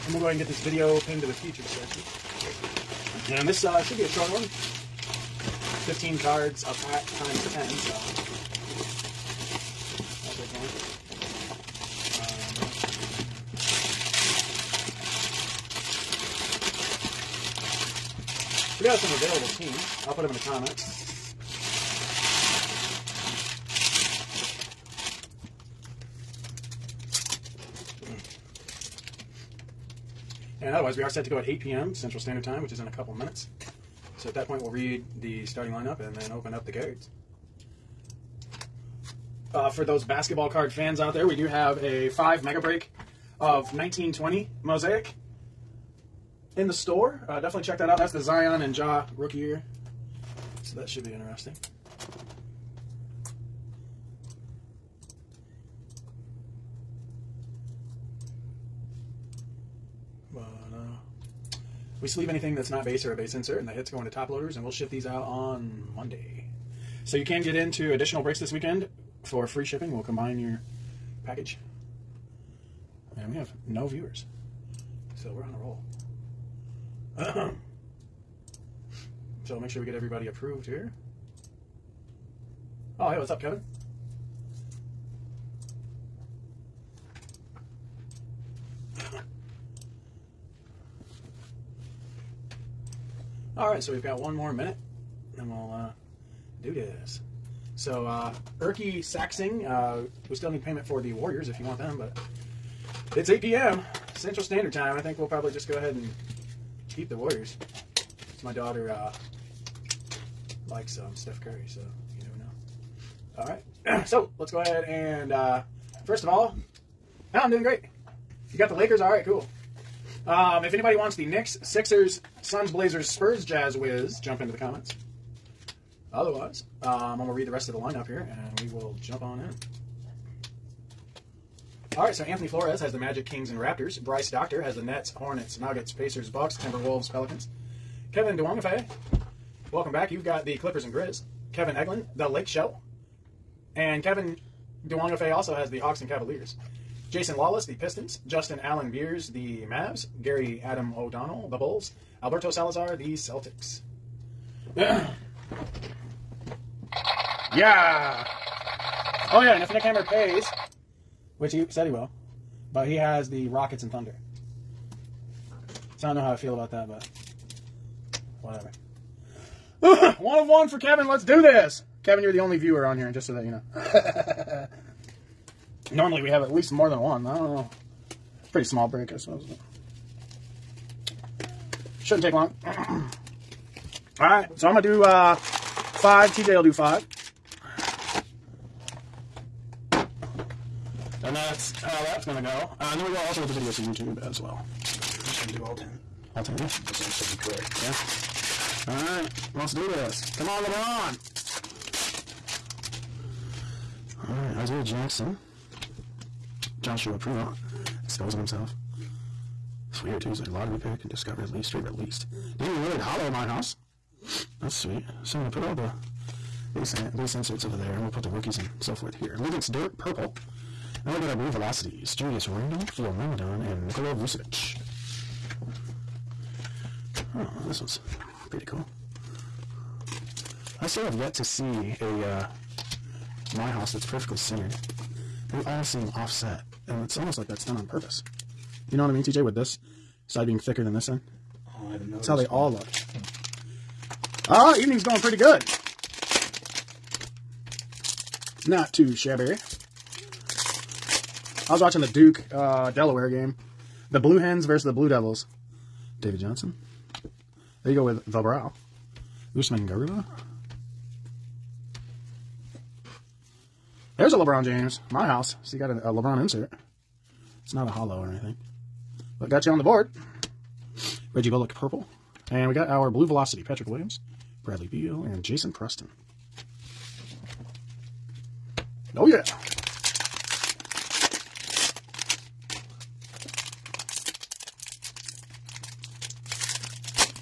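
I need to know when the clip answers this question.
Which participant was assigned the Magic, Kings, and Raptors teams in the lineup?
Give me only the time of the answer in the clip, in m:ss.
2:12.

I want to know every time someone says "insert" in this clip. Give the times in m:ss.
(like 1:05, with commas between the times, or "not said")
1:03, 3:37, 4:26.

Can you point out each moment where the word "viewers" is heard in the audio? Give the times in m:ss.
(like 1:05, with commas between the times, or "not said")
1:13, 2:52.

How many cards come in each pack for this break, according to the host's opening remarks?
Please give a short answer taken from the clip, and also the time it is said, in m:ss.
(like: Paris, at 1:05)
15, at 0:05.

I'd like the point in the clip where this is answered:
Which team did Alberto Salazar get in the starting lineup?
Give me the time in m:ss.
2:32.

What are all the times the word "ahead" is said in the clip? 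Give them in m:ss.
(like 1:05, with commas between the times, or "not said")
0:00, 1:45, 1:54.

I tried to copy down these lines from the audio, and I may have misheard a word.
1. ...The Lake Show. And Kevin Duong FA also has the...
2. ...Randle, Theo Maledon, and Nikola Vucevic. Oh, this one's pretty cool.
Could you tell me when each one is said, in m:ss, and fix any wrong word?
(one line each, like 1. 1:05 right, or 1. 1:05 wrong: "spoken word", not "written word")
1. 2:22 right
2. 3:42 right.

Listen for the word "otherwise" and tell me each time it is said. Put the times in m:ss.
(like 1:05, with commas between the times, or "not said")
0:30, 2:06.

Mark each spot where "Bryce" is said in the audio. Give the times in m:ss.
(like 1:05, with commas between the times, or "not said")
2:14.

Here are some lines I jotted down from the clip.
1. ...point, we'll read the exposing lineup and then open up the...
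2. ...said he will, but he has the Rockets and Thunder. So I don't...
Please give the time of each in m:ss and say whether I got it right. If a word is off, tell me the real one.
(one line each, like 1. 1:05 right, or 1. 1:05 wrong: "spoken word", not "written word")
1. 0:34 wrong: "starting", not "exposing"
2. 2:41 right.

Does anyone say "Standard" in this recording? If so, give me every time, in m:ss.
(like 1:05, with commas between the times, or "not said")
0:32, 1:44.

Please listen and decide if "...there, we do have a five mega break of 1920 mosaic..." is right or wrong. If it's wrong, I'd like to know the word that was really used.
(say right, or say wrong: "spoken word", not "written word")
right.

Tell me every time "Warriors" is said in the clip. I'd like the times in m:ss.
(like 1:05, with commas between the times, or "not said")
1:41, 1:47.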